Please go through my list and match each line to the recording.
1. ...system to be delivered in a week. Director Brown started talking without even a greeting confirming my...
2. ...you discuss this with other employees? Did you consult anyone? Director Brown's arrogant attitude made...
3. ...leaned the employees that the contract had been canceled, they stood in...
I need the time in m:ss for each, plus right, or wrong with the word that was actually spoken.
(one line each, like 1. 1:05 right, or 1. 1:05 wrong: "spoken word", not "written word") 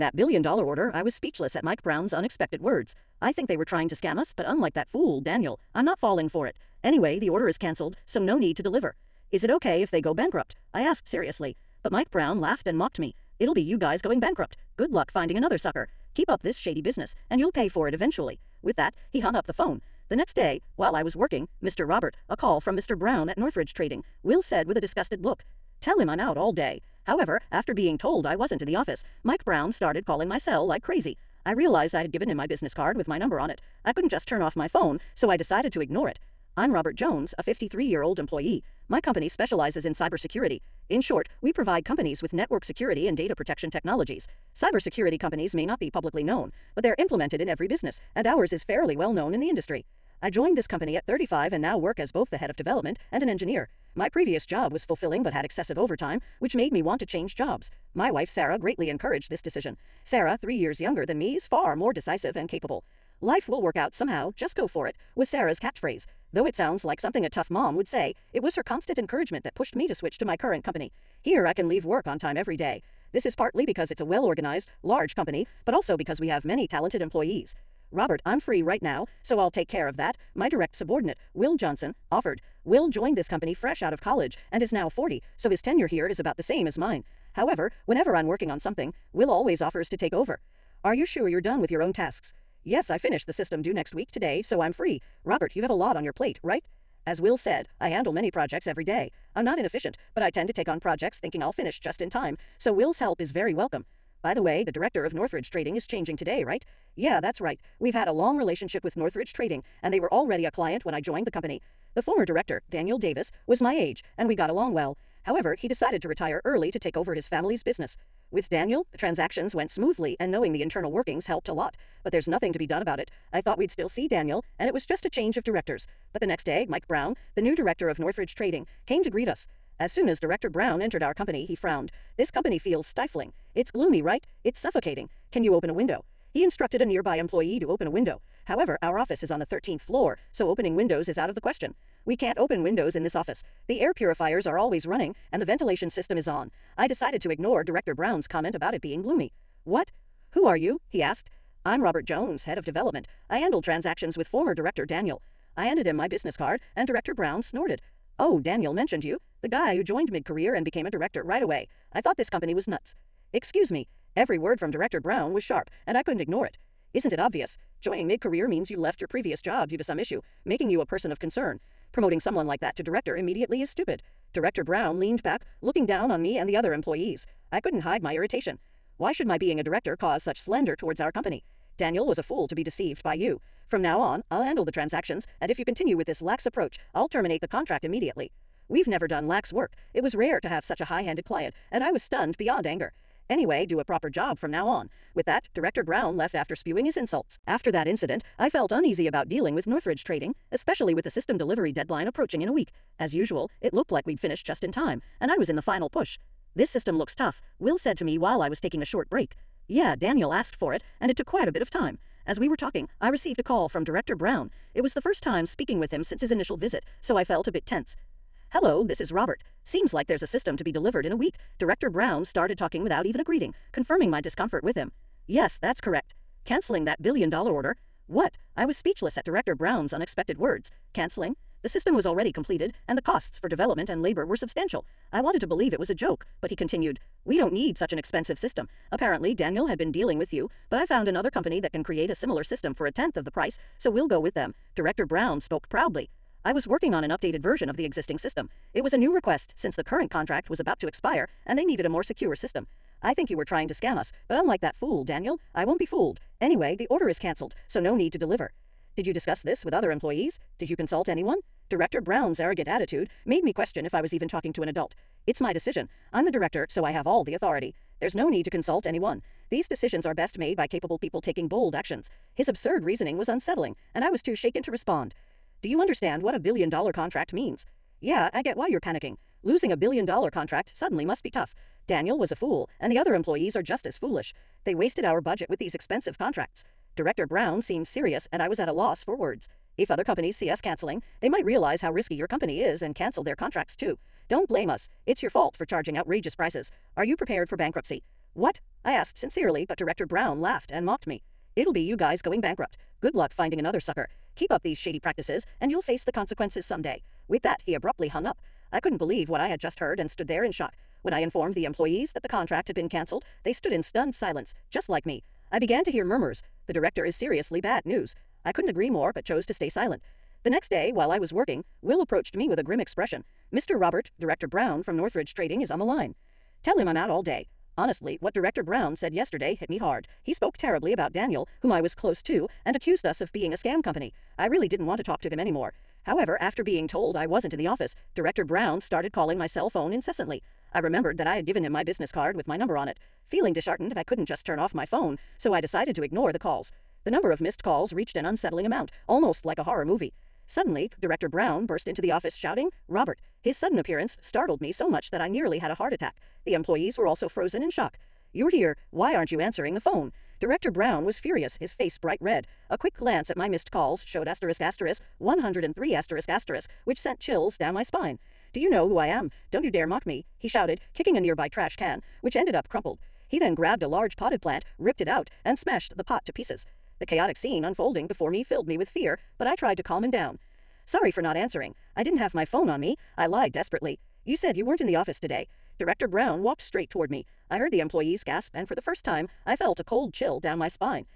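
1. 3:40 right
2. 4:19 right
3. 5:11 wrong: "informed", not "leaned".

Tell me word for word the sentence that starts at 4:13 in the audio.
I think you were trying to scam us, but unlike that fool, Daniel, I won't be fooled.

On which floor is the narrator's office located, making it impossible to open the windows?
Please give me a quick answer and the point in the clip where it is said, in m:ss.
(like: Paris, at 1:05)
13th, at 2:19.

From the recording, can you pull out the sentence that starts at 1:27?
However, whenever I'm working on something, Will always offers to take over.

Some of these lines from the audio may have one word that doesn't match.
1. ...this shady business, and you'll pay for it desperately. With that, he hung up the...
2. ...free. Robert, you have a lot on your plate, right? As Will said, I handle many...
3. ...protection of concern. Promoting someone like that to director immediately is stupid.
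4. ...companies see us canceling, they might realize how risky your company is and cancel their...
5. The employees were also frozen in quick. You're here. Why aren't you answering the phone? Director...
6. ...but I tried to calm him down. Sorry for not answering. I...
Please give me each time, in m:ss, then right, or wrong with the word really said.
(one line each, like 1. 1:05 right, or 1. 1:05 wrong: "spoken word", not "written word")
1. 0:16 wrong: "eventually", not "desperately"
2. 1:34 right
3. 2:50 wrong: "person", not "protection"
4. 4:50 right
5. 5:56 wrong: "shock", not "quick"
6. 6:19 right.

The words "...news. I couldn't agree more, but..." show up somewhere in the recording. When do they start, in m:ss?
5:17.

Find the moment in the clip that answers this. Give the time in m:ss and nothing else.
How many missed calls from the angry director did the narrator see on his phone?
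6:05.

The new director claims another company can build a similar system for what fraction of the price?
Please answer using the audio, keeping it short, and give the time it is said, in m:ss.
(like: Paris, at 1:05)
a tenth, at 4:02.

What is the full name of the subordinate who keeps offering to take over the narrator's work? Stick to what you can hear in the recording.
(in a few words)
Will Johnson.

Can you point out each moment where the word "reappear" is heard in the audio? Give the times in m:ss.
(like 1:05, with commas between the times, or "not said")
not said.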